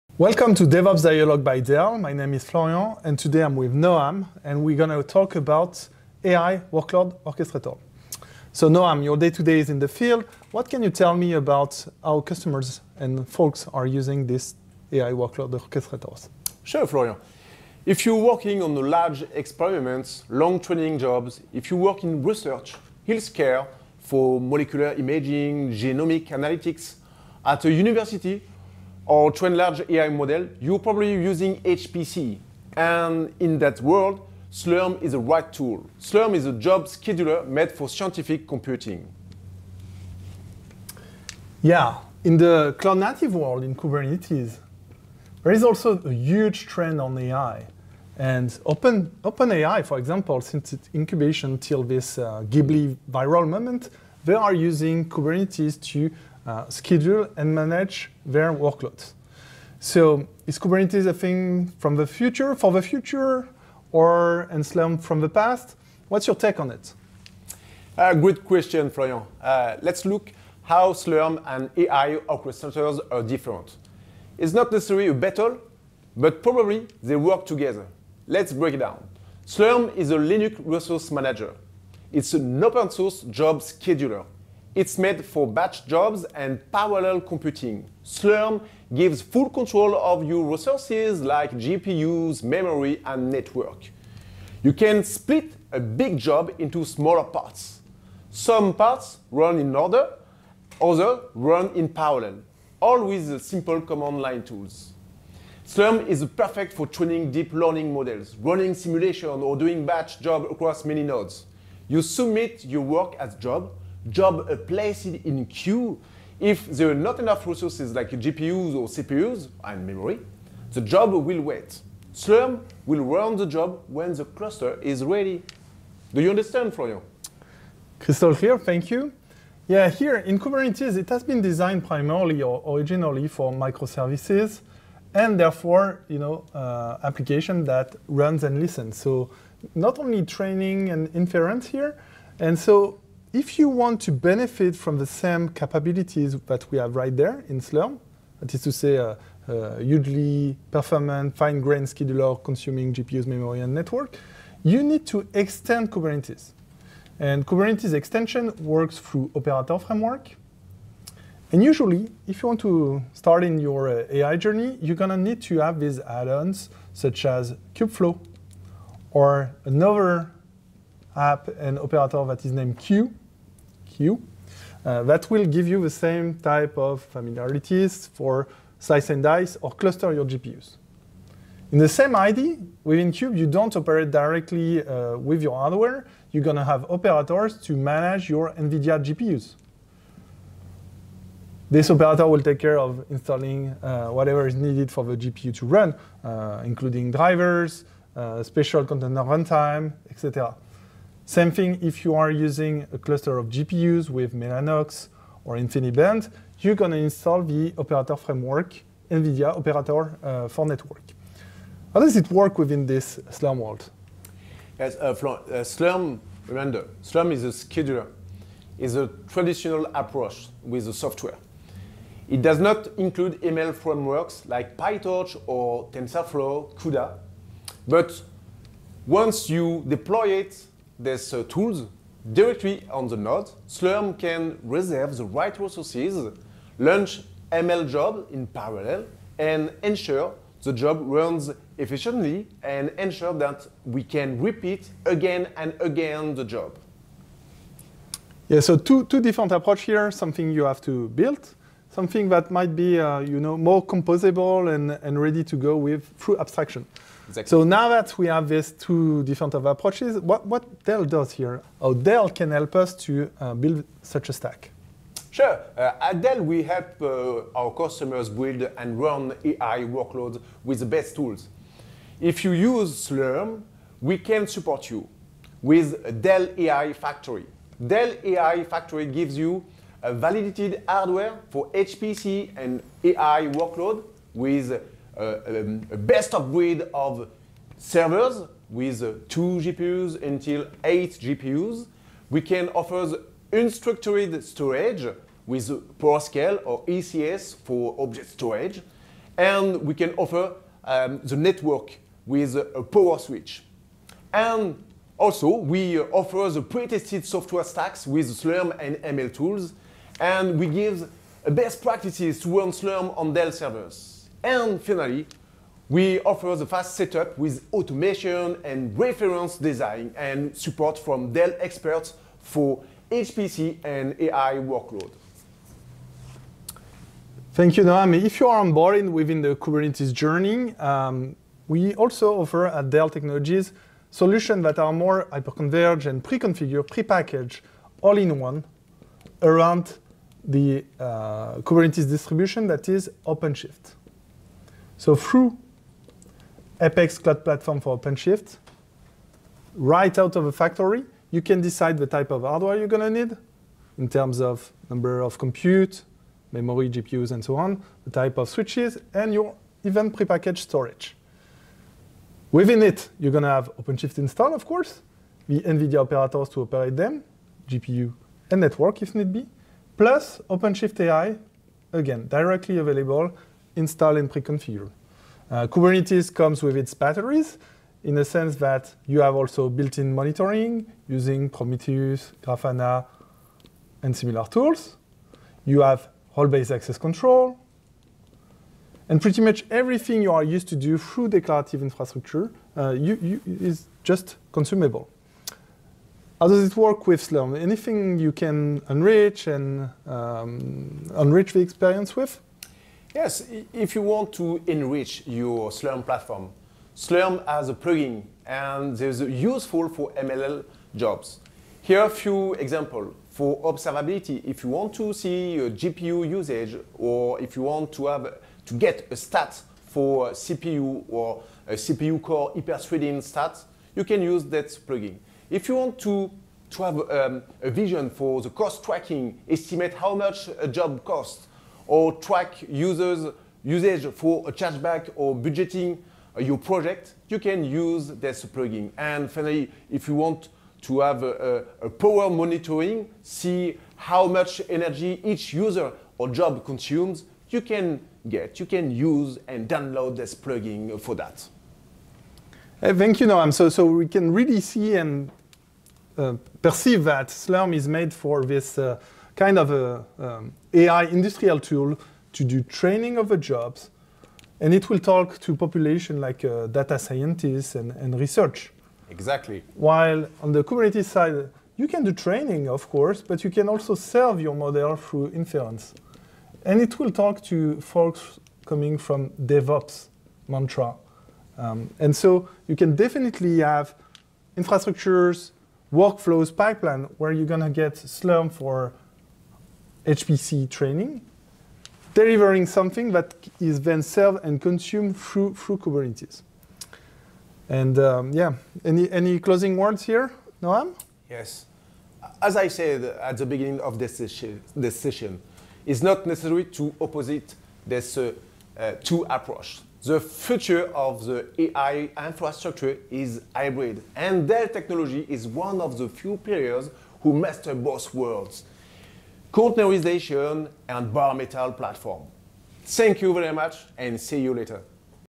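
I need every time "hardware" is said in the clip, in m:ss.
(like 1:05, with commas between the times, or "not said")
3:05, 4:40, 5:52.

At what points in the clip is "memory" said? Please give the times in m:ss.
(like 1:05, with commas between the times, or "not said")
1:32, 1:59, 2:33, 5:56.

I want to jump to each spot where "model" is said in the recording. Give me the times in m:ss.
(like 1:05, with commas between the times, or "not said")
0:30, 1:47, 7:54.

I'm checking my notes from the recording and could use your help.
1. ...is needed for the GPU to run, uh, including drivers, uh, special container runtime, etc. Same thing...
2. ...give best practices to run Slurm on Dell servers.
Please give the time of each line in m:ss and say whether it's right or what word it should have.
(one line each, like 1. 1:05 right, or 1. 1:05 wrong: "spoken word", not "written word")
1. 3:14 right
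2. 5:10 right.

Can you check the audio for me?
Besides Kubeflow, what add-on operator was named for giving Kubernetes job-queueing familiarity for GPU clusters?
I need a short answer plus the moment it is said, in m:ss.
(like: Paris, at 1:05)
Kueue, at 2:52.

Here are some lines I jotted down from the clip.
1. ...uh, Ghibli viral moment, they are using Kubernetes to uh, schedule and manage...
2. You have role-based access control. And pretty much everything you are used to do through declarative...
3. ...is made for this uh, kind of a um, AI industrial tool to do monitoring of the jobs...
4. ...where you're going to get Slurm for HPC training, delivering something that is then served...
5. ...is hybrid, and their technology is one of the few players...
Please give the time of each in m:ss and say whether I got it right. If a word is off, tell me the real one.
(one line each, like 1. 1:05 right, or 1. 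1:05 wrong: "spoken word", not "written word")
1. 0:52 right
2. 6:25 right
3. 7:37 wrong: "training", not "monitoring"
4. 8:07 right
5. 8:33 right.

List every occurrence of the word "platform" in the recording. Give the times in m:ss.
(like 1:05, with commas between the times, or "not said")
5:47, 6:46, 8:41.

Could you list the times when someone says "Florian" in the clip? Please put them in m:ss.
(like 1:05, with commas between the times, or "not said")
0:02, 0:16, 1:08, 2:06.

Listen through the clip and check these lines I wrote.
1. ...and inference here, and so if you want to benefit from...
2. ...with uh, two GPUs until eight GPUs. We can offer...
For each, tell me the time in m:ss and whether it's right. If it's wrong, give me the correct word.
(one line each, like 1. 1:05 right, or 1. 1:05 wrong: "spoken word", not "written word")
1. 2:20 right
2. 4:48 right.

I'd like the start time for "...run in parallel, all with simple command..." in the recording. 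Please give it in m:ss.
1:41.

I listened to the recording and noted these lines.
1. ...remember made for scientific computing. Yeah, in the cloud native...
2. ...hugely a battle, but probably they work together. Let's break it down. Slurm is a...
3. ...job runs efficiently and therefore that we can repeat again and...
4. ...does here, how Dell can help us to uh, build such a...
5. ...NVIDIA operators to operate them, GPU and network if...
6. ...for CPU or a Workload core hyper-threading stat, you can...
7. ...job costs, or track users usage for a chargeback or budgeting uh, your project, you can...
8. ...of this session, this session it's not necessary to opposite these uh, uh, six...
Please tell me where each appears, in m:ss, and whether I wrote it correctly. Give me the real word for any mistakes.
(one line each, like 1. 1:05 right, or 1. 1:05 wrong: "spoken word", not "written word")
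1. 0:36 wrong: "scheduler", not "remember"
2. 1:14 wrong: "necessarily", not "hugely"
3. 4:00 wrong: "ensure", not "therefore"
4. 4:21 right
5. 6:05 right
6. 6:59 wrong: "CPU", not "Workload"
7. 7:10 right
8. 8:23 wrong: "two", not "six".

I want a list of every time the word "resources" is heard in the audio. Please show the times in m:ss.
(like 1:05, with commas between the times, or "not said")
1:20, 1:30, 1:57, 3:55.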